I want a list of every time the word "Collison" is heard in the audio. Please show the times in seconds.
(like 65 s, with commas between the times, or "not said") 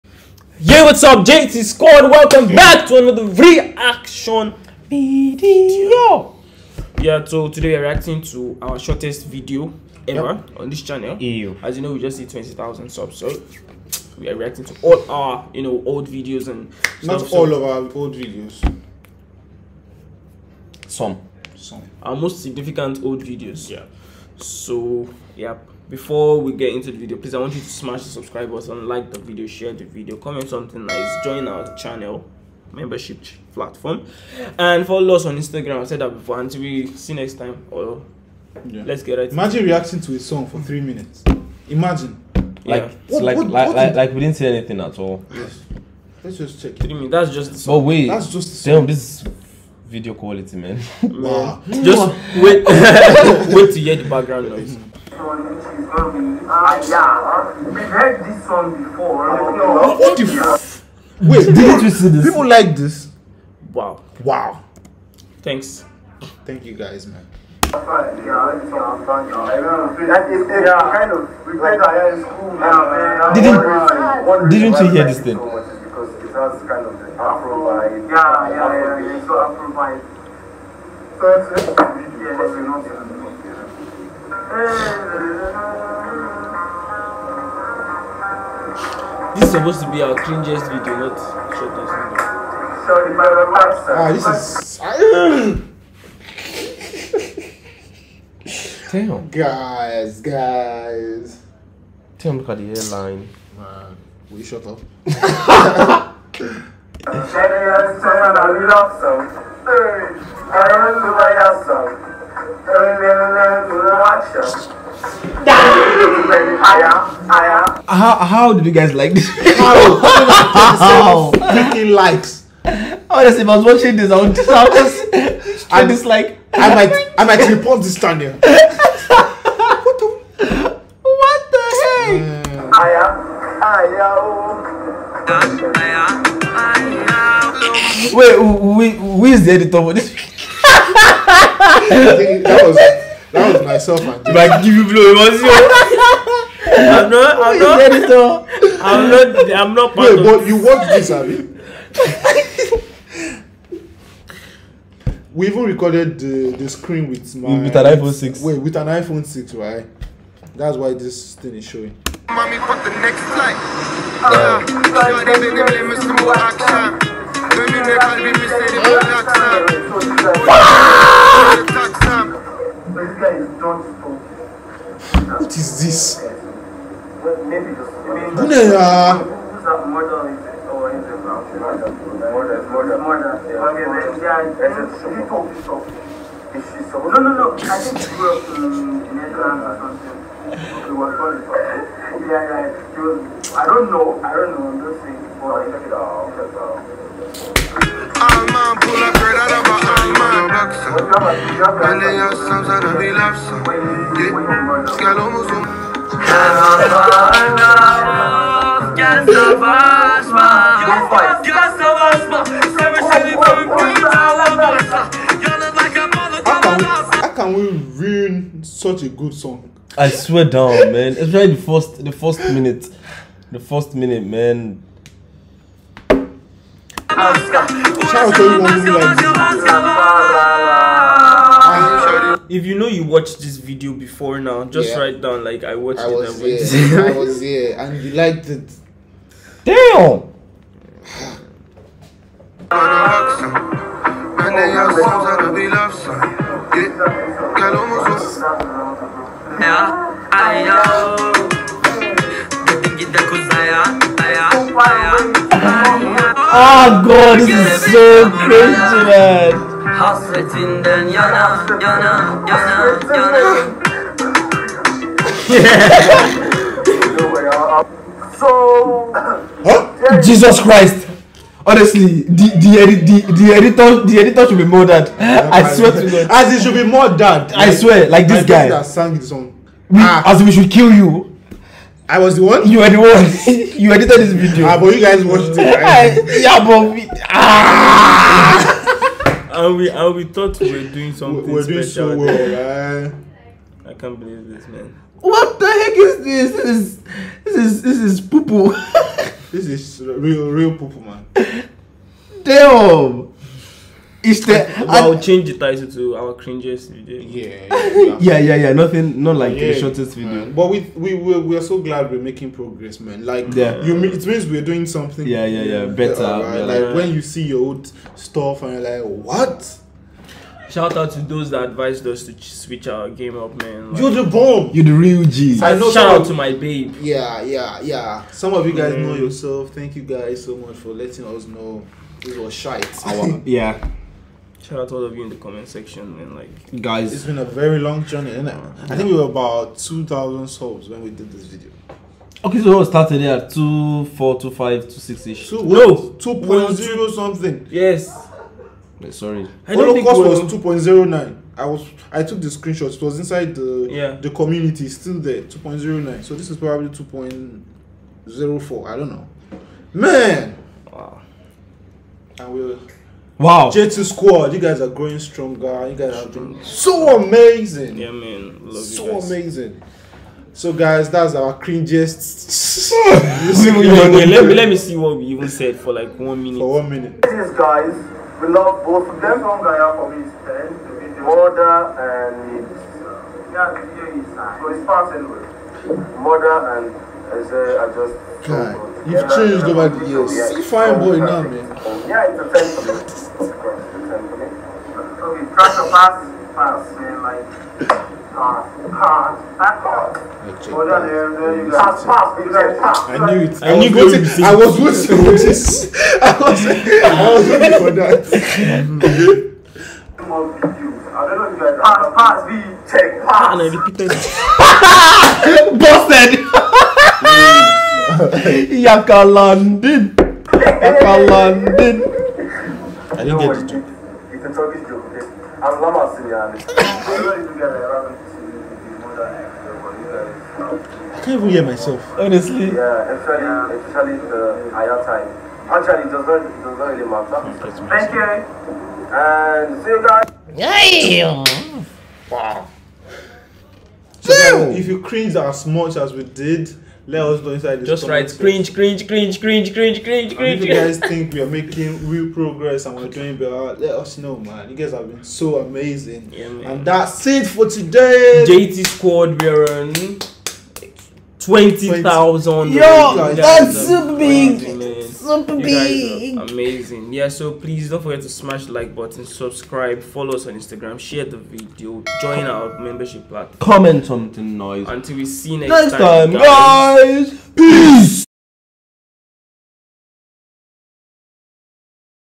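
not said.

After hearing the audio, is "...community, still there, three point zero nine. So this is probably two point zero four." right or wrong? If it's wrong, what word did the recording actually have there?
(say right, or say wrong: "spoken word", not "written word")
wrong: "two", not "three".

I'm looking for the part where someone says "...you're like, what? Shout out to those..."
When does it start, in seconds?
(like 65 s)
318 s.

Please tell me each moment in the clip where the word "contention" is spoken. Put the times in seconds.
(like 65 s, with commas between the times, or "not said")
not said.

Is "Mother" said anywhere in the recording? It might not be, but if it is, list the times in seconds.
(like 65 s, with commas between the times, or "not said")
381 s, 386 s.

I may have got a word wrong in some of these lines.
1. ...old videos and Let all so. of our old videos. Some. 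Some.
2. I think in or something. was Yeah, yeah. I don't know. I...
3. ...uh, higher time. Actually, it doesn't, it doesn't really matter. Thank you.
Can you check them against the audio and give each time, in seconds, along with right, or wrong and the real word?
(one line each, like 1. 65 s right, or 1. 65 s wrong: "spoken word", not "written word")
1. 15 s wrong: "Not", not "Let"
2. 187 s right
3. 434 s right.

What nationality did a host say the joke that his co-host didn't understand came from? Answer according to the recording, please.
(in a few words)
Turkish.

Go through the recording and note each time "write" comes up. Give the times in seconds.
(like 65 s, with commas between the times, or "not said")
234 s, 448 s.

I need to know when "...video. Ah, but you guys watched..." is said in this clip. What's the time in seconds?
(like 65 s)
284 s.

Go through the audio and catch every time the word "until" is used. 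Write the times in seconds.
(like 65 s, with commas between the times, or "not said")
36 s, 474 s.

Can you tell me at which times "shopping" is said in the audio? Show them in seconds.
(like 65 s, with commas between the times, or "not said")
not said.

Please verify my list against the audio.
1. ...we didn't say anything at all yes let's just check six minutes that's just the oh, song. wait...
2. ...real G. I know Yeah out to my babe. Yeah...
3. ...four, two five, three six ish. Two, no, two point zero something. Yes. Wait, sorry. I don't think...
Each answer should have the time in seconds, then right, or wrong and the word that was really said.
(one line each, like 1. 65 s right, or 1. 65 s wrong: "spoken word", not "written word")
1. 44 s wrong: "three", not "six"
2. 324 s wrong: "Shout", not "Yeah"
3. 344 s wrong: "two", not "three".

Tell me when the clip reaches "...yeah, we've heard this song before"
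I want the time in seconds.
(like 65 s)
56 s.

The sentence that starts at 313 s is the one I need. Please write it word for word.
you, it means we're doing something.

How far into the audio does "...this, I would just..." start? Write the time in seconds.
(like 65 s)
123 s.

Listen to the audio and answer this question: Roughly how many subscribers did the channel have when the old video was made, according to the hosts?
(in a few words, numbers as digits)
2,000.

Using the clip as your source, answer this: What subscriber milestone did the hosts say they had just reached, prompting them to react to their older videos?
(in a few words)
20,000.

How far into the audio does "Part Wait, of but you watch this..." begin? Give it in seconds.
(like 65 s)
149 s.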